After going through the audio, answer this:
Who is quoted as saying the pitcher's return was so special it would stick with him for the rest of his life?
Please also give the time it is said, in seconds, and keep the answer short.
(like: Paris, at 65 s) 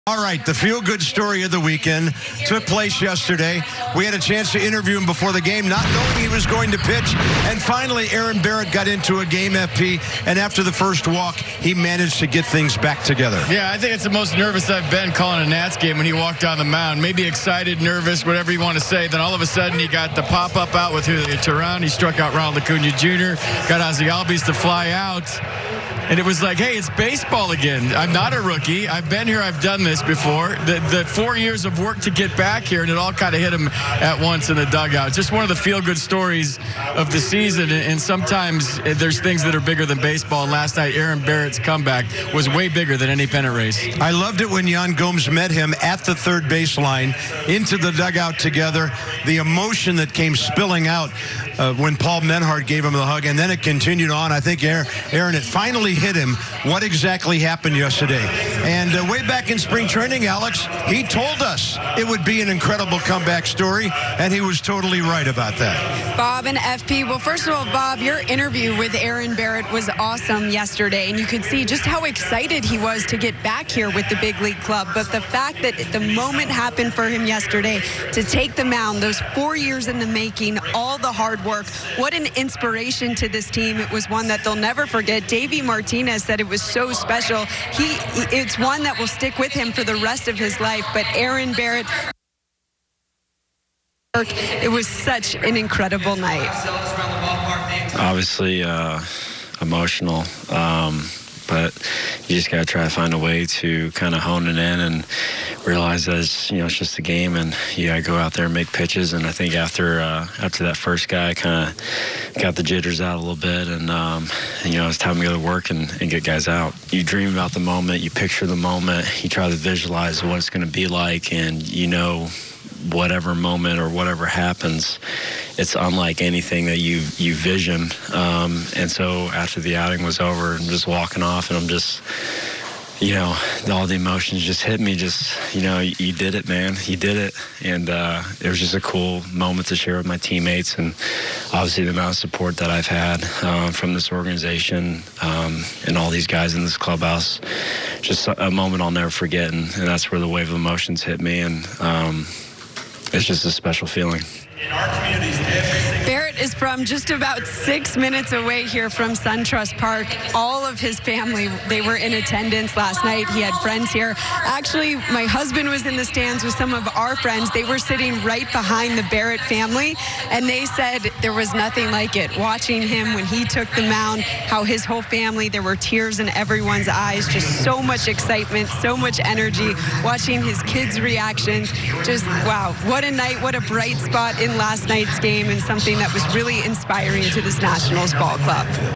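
Davey Martinez, at 85 s.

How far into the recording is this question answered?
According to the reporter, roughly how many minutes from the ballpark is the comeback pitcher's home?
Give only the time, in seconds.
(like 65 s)
157 s.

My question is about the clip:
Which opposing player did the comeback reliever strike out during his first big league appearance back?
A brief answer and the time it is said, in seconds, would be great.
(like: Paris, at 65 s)
Ronald Acuna Jr., at 22 s.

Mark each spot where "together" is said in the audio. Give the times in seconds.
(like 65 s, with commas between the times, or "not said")
13 s, 48 s.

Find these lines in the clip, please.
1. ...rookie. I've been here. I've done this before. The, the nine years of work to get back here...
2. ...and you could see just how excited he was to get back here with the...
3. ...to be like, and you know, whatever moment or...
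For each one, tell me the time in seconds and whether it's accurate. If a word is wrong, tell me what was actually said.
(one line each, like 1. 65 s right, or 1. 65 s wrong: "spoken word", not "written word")
1. 28 s wrong: "four", not "nine"
2. 71 s right
3. 120 s right.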